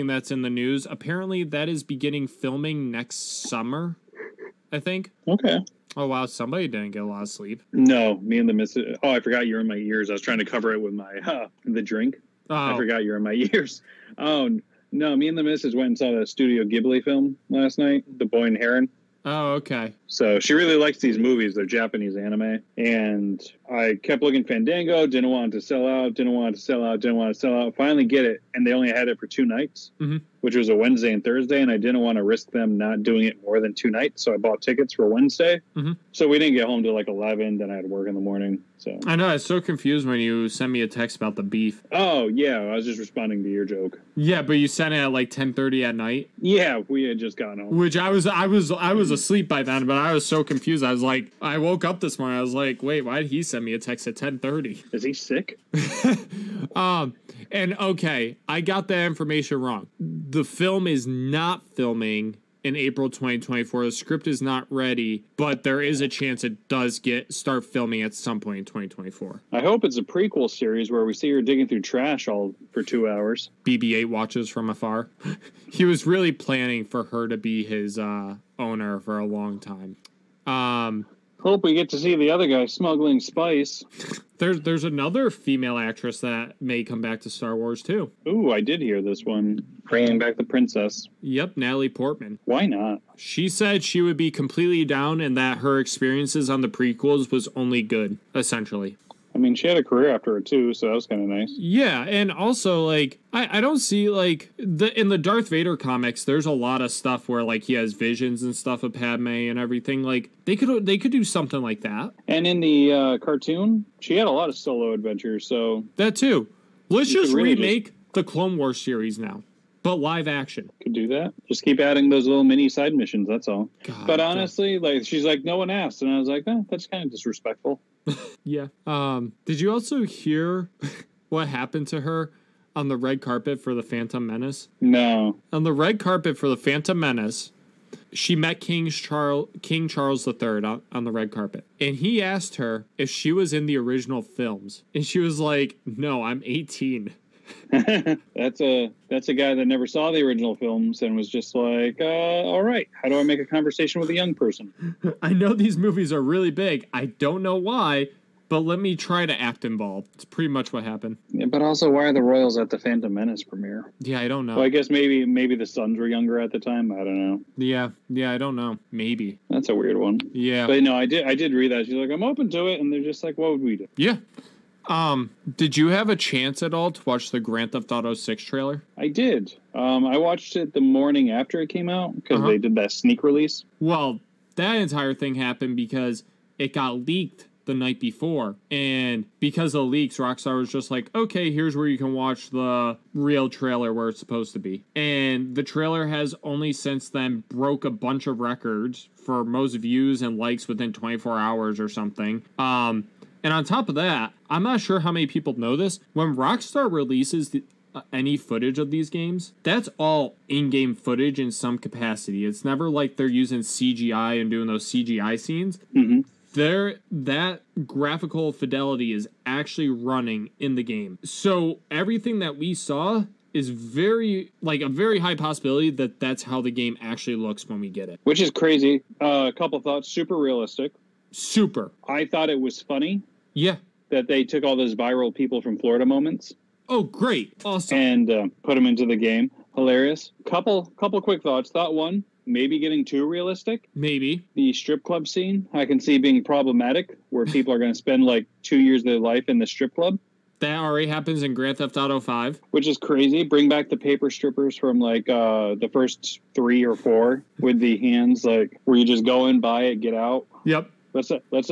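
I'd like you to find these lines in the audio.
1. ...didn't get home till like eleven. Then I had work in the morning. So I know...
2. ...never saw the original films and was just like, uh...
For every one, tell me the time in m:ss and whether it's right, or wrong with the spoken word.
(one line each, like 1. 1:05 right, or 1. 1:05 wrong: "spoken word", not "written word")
1. 0:36 right
2. 2:29 right.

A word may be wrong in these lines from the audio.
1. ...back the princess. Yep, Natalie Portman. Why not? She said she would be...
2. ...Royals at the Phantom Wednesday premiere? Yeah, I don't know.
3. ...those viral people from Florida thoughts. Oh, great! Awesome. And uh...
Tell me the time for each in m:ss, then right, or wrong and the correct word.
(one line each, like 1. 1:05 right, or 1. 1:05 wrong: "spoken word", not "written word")
1. 1:30 right
2. 2:42 wrong: "Menace", not "Wednesday"
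3. 3:54 wrong: "moments", not "thoughts".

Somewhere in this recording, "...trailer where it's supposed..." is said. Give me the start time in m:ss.
3:13.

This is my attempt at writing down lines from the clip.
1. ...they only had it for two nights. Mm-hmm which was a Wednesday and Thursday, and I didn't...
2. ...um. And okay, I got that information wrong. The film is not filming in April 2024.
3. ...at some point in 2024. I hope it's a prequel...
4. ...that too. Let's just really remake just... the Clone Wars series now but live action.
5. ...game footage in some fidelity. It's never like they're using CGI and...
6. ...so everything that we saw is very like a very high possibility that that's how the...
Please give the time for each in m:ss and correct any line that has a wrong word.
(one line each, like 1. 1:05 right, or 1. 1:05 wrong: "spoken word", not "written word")
1. 0:28 right
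2. 0:56 right
3. 1:08 right
4. 1:55 right
5. 3:30 wrong: "capacity", not "fidelity"
6. 3:41 right.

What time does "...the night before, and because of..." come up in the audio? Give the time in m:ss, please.
3:07.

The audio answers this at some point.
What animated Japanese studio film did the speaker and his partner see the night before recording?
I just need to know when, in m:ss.
0:18.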